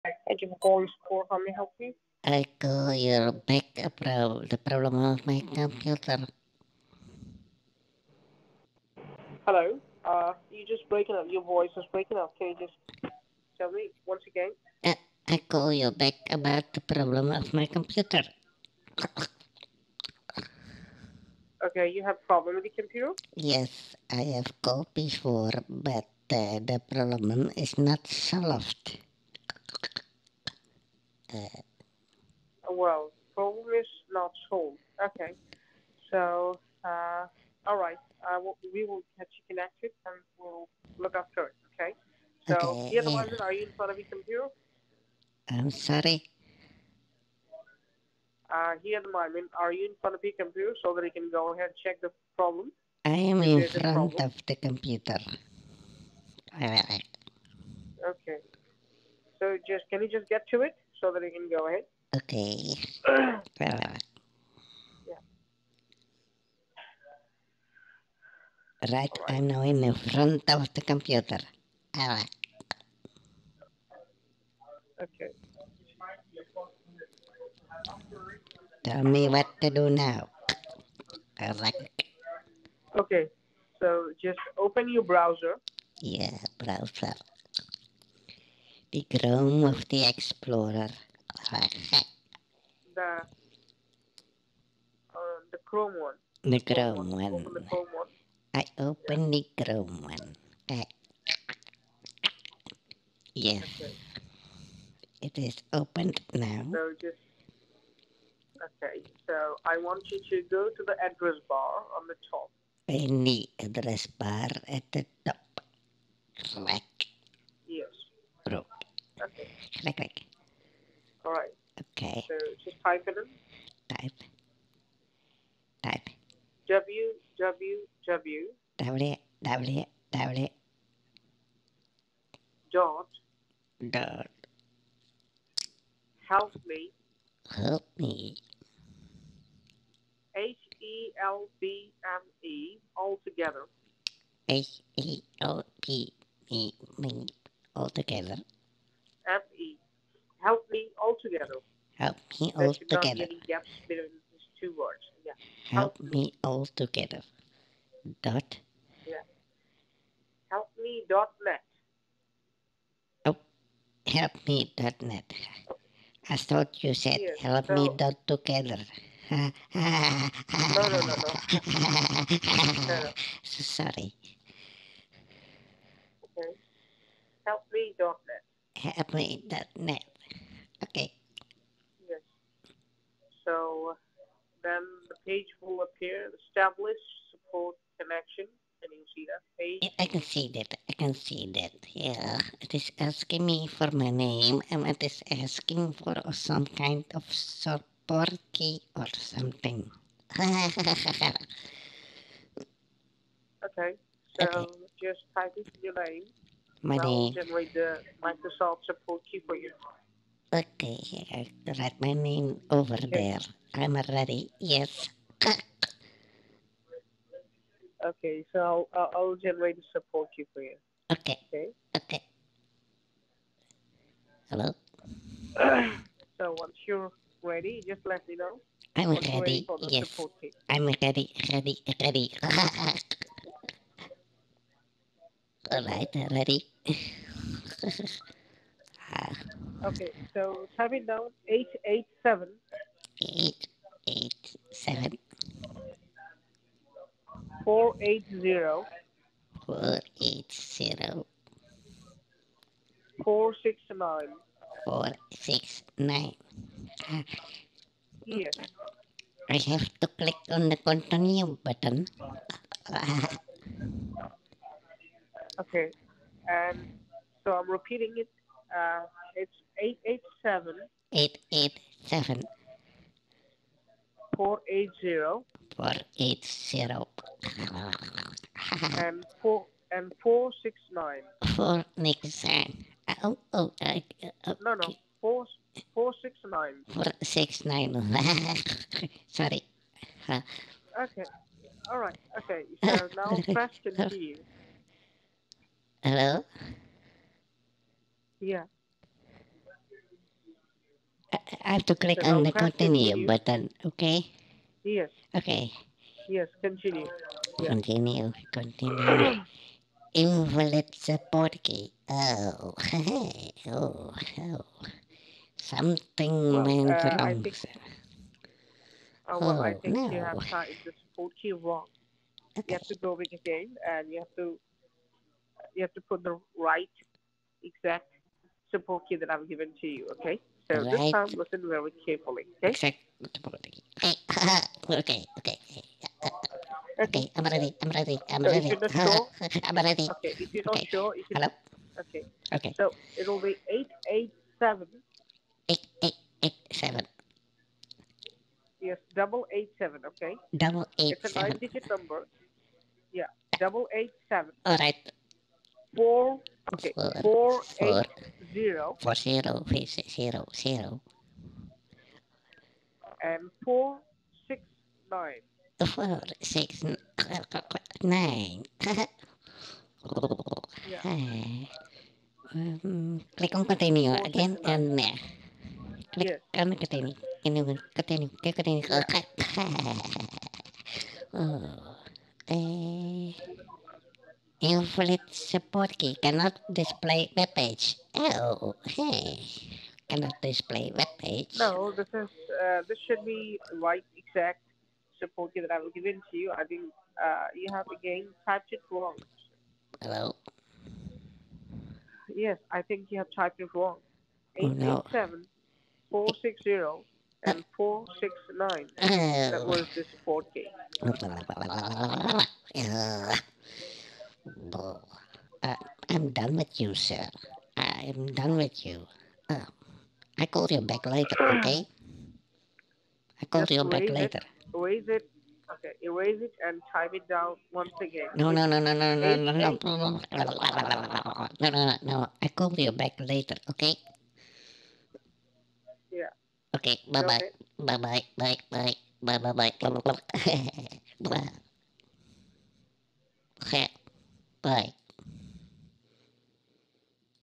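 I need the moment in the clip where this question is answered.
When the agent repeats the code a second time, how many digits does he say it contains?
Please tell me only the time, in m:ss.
5:51.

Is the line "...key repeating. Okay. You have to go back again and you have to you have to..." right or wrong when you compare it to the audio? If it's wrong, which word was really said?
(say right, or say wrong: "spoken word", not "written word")
wrong: "wrong", not "repeating".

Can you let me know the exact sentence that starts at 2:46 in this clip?
I thought you said yes, help so, me dot together.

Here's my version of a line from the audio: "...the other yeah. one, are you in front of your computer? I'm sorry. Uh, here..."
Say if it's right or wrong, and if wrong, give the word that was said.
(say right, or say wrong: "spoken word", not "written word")
right.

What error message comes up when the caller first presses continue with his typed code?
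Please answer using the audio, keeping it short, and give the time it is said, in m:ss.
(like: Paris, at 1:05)
Invalid support key, at 5:10.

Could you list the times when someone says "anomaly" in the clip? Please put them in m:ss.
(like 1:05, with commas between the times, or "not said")
not said.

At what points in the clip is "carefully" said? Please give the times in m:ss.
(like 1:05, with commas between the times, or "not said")
5:32.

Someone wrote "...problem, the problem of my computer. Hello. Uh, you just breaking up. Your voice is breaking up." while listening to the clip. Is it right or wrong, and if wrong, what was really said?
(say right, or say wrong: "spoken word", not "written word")
right.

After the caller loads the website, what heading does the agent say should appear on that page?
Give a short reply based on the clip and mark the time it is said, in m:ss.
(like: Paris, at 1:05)
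Establish support connection, at 3:06.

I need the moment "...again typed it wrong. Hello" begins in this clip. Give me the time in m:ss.
6:37.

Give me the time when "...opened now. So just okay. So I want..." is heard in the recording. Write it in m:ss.
1:45.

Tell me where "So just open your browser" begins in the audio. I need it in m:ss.
1:23.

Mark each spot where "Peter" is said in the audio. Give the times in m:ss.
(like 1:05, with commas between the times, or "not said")
not said.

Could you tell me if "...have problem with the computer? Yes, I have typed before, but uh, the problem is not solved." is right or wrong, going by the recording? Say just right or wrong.
wrong.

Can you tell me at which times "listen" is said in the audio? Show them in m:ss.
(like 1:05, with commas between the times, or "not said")
5:31.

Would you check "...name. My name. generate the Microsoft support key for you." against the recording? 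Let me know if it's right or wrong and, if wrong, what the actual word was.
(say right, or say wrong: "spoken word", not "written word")
right.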